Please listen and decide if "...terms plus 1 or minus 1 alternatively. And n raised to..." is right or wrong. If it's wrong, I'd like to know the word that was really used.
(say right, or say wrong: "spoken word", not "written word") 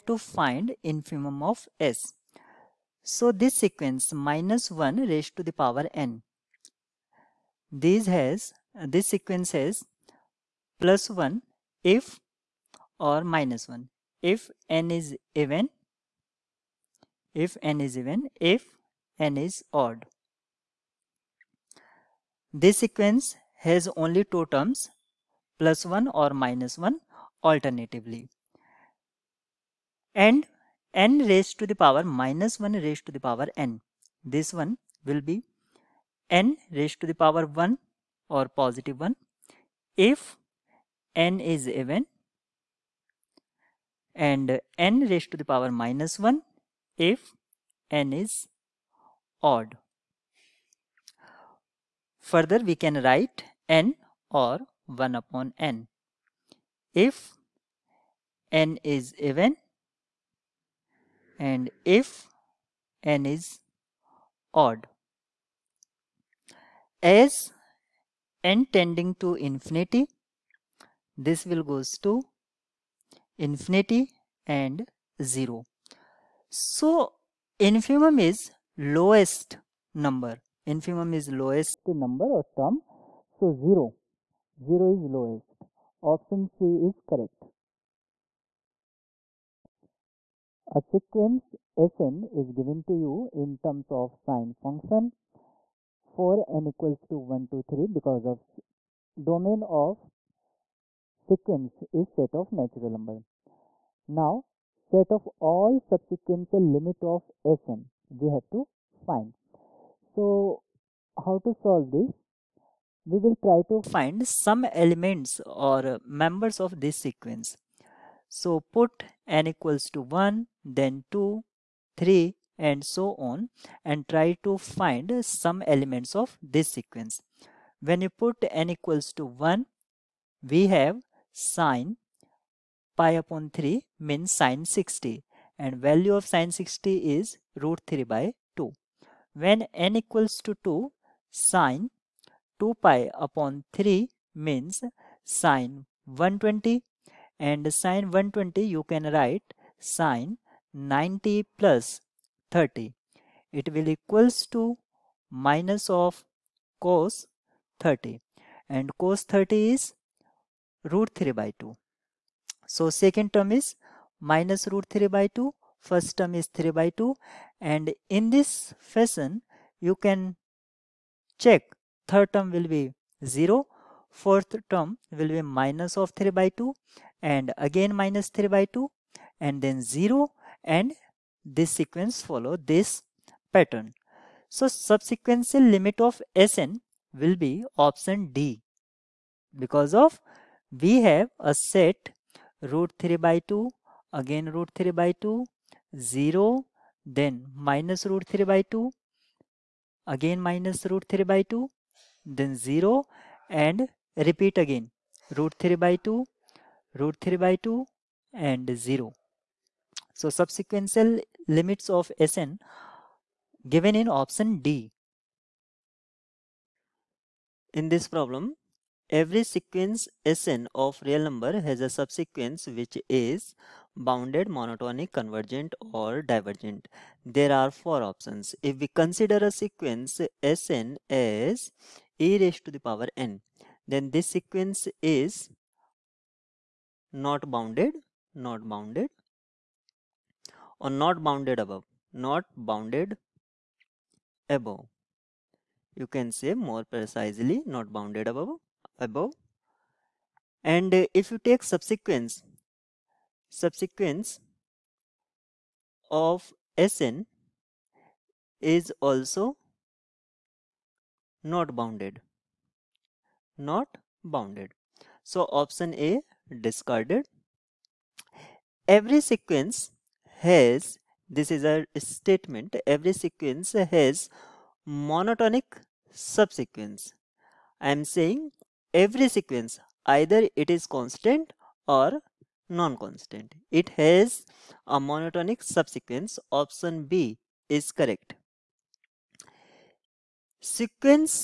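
right.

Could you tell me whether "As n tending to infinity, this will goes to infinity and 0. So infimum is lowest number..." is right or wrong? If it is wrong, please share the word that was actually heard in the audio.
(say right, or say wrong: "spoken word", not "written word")
right.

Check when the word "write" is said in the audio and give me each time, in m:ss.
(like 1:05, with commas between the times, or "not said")
0:53, 2:29.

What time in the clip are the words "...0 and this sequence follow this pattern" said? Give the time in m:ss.
2:59.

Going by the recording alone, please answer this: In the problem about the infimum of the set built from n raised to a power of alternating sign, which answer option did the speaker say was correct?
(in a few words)
Option C.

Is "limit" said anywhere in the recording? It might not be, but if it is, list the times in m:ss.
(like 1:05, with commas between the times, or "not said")
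1:46, 3:05, 3:31.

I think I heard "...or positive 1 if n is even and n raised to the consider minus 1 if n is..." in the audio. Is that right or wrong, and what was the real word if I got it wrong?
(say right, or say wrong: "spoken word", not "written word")
wrong: "power", not "consider".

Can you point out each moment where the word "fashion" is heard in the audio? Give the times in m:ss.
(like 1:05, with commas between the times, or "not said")
2:48.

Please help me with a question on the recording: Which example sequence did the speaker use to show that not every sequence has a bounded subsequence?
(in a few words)
e raised to the power n.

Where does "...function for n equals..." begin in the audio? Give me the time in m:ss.
1:34.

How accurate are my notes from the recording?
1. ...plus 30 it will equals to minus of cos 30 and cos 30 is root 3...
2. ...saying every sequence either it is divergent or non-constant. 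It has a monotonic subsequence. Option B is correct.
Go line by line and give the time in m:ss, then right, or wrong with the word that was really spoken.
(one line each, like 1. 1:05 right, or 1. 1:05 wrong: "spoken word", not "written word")
1. 2:31 right
2. 4:38 wrong: "constant", not "divergent".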